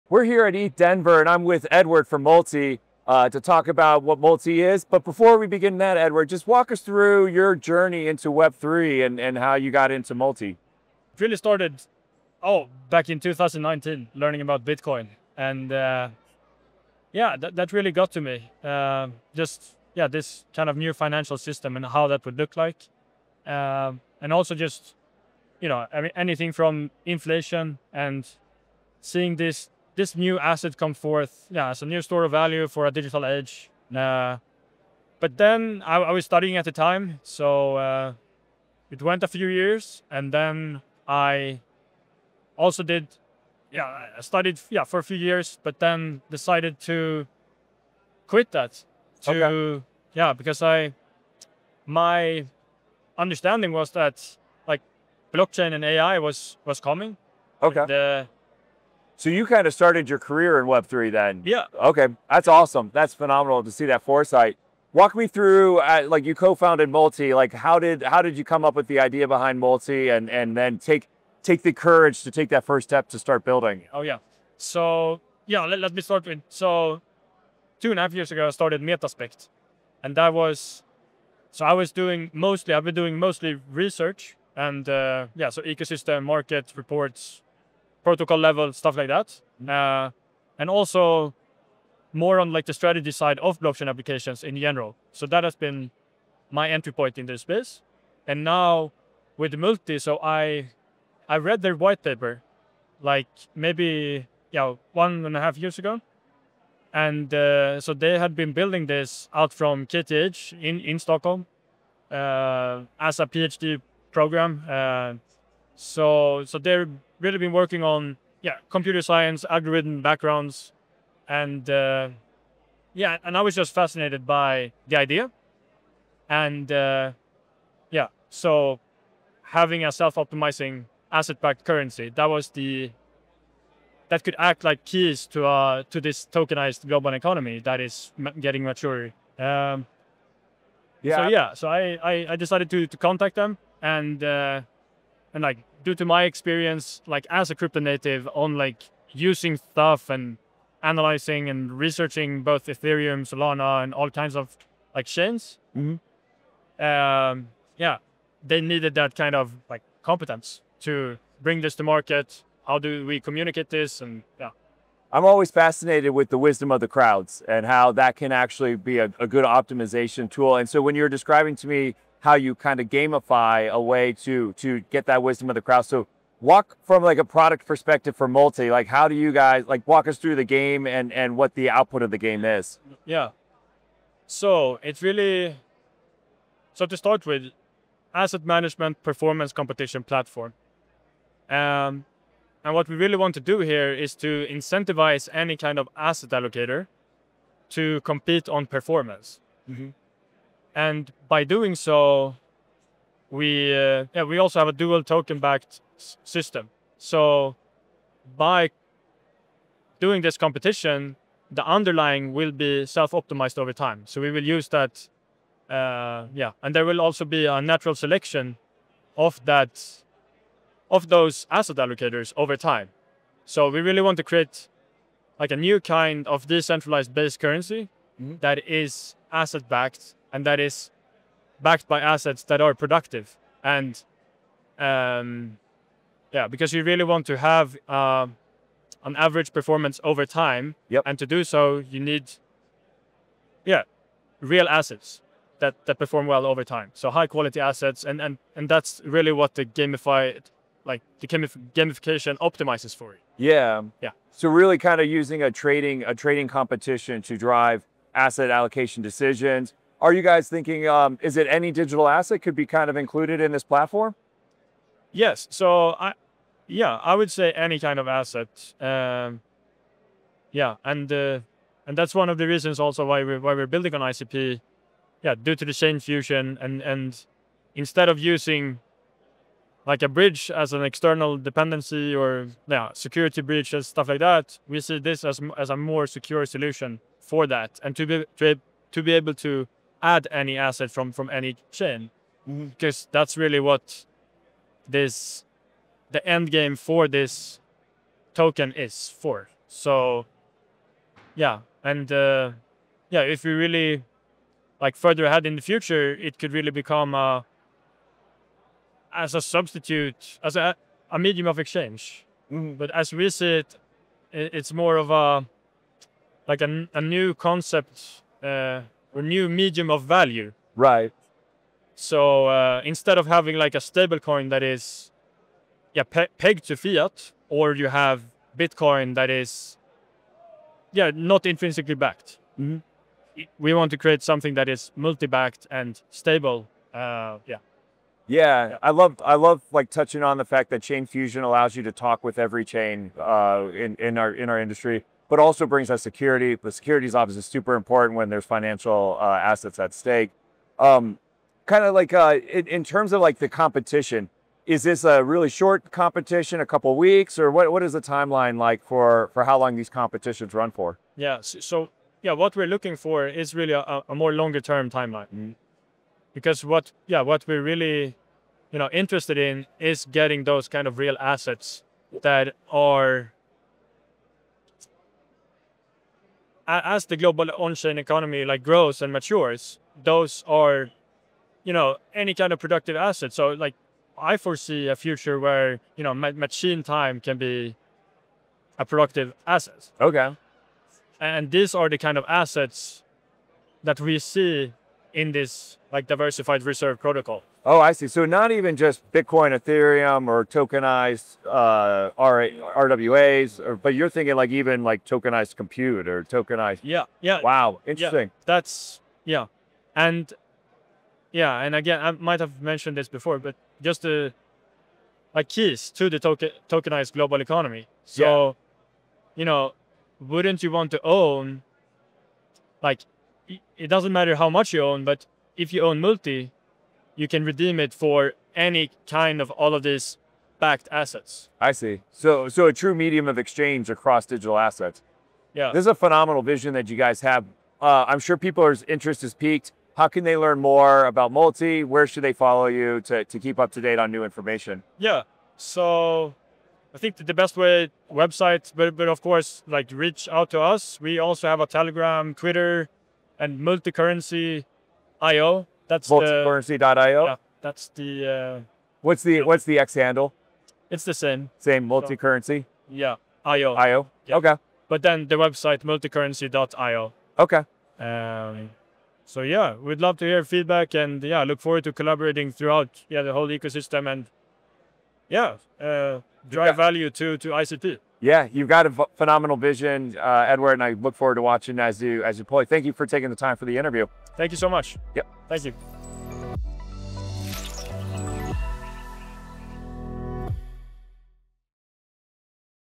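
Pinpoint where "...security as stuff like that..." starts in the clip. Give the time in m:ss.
4:42.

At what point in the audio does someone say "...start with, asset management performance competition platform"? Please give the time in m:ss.
3:06.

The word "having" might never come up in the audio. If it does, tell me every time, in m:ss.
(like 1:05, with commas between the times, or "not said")
2:09, 5:23.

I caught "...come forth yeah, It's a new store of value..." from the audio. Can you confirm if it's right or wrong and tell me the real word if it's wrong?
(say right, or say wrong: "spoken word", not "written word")
right.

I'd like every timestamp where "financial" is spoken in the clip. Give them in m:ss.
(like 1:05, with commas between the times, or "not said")
0:20, 5:48.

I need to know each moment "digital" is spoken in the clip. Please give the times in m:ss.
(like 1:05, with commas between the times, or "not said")
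0:32, 4:21, 7:14.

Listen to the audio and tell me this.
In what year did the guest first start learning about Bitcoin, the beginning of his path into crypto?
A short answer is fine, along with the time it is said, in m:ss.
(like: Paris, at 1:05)
2019, at 0:13.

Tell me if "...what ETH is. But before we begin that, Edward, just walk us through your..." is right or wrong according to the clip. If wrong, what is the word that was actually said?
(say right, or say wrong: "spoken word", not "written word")
wrong: "Multi", not "ETH".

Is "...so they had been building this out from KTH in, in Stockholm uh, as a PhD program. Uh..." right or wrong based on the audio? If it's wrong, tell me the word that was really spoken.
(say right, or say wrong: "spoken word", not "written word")
right.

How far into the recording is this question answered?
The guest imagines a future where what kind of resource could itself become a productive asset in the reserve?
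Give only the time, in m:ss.
6:26.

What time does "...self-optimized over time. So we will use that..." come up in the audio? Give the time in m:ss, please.
3:32.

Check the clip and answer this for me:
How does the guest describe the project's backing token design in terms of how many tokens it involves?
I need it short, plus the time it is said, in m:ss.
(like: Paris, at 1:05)
Dual token backed system, at 3:24.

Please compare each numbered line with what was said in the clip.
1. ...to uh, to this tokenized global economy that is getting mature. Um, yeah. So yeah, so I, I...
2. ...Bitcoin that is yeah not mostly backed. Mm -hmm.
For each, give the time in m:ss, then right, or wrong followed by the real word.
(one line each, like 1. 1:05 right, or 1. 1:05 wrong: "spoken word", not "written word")
1. 2:15 right
2. 5:28 wrong: "intrinsically", not "mostly".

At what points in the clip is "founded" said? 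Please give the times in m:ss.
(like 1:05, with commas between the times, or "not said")
1:06.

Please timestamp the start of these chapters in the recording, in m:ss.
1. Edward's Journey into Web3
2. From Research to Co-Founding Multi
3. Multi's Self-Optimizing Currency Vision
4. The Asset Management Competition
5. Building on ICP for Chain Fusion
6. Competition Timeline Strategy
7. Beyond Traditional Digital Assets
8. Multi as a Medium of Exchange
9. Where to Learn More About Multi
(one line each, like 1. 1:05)
1. 0:30
2. 1:25
3. 2:40
4. 3:30
5. 4:15
6. 5:10
7. 6:00
8. 7:00
9. 7:35.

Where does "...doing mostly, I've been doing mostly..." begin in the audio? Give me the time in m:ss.
1:21.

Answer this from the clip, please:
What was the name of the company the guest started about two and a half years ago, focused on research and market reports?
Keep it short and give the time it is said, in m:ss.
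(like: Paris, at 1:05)
Metaspect, at 1:18.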